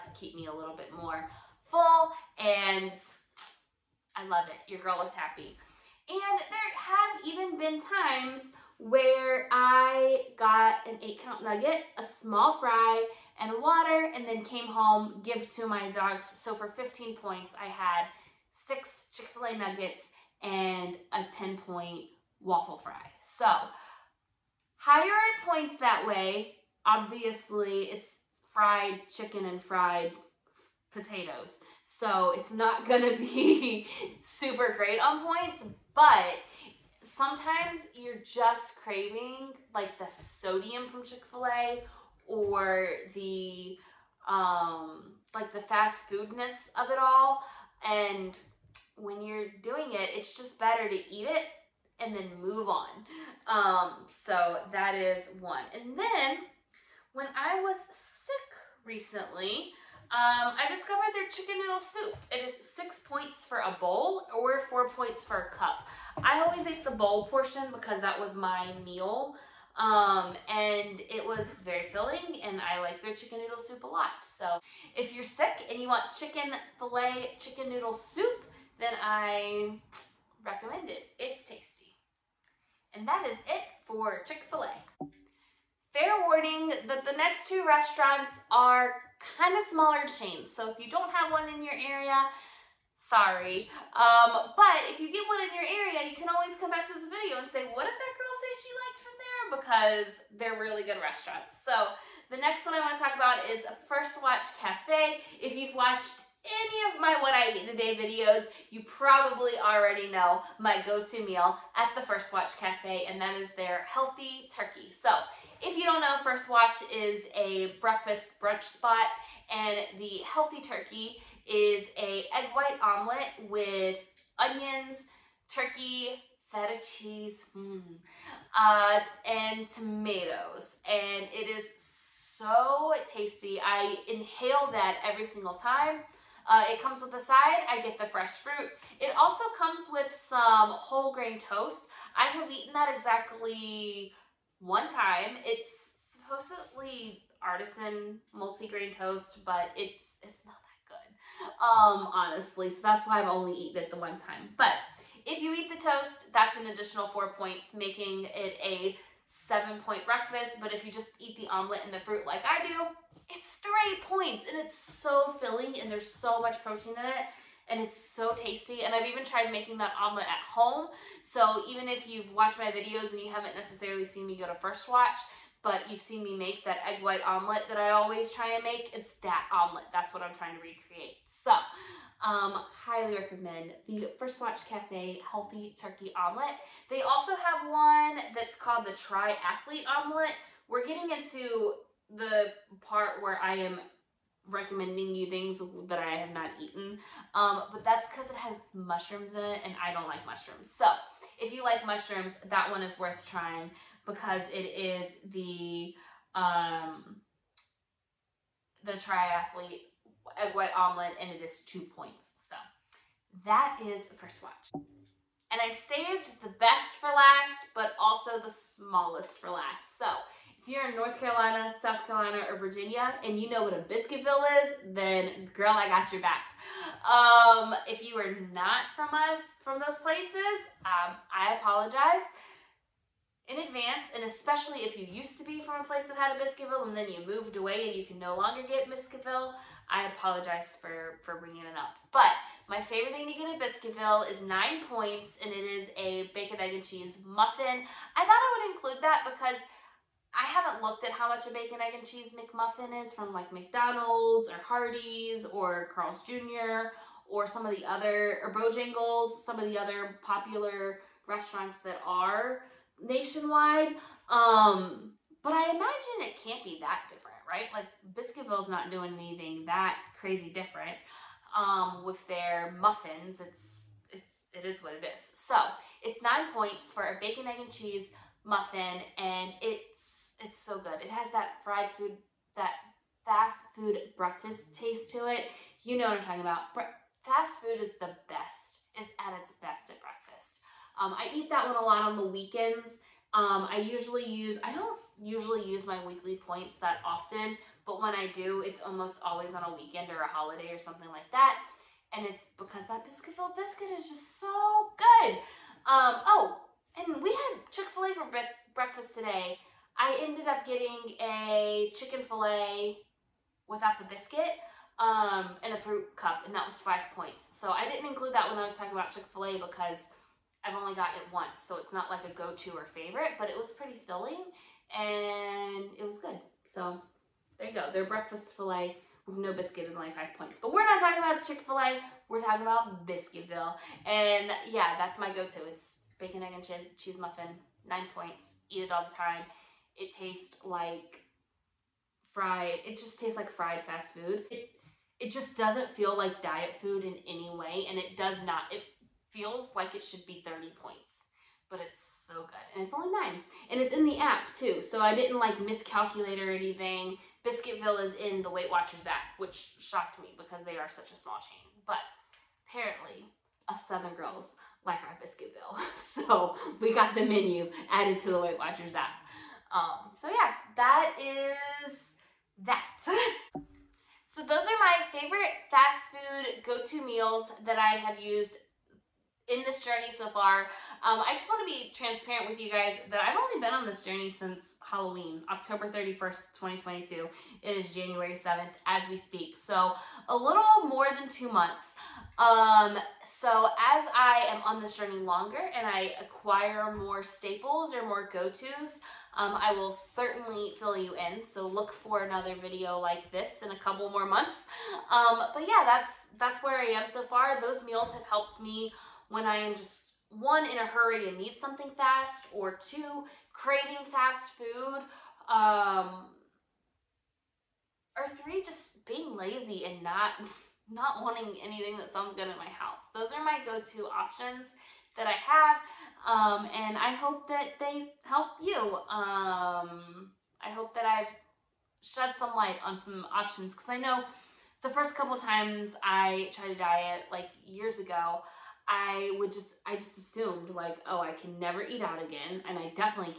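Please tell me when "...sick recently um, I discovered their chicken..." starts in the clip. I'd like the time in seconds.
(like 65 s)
57 s.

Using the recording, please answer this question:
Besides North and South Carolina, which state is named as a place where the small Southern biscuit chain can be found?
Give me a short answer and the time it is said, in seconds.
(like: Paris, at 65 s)
Virginia, at 222 s.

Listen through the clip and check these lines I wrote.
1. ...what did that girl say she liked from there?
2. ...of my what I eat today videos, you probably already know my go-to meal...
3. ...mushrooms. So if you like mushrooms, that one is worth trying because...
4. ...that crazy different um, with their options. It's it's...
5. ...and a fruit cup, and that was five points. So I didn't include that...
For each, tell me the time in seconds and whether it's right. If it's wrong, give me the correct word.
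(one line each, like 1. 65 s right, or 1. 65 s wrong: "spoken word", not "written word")
1. 97 s right
2. 106 s right
3. 200 s right
4. 269 s wrong: "muffins", not "options"
5. 315 s right.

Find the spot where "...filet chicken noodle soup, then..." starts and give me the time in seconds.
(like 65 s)
76 s.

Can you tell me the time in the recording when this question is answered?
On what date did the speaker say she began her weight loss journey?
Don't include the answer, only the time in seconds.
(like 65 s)
385 s.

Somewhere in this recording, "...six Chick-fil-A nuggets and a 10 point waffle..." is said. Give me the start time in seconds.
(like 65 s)
18 s.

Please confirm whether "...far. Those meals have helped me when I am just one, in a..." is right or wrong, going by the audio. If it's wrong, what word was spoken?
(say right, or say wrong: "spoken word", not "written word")
right.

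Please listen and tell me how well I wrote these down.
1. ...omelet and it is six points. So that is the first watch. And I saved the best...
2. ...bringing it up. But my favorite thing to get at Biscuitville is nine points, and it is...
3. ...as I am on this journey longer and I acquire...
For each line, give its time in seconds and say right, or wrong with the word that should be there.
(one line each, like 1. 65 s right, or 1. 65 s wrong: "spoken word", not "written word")
1. 210 s wrong: "two", not "six"
2. 241 s right
3. 393 s right.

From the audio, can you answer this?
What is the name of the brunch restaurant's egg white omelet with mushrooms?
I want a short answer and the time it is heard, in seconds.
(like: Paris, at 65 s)
Triathlete Omelet, at 188 s.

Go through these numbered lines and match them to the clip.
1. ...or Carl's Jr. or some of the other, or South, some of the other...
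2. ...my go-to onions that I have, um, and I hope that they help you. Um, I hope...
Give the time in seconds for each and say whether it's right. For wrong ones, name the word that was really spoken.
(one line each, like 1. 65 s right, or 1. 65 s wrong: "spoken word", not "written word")
1. 255 s wrong: "Bojangles", not "South"
2. 423 s wrong: "options", not "onions".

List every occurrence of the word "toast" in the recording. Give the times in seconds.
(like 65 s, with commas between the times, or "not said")
141 s, 148 s, 155 s.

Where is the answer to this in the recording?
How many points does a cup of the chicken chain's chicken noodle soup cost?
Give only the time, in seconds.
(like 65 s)
64 s.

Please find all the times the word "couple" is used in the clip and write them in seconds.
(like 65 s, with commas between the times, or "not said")
403 s, 435 s.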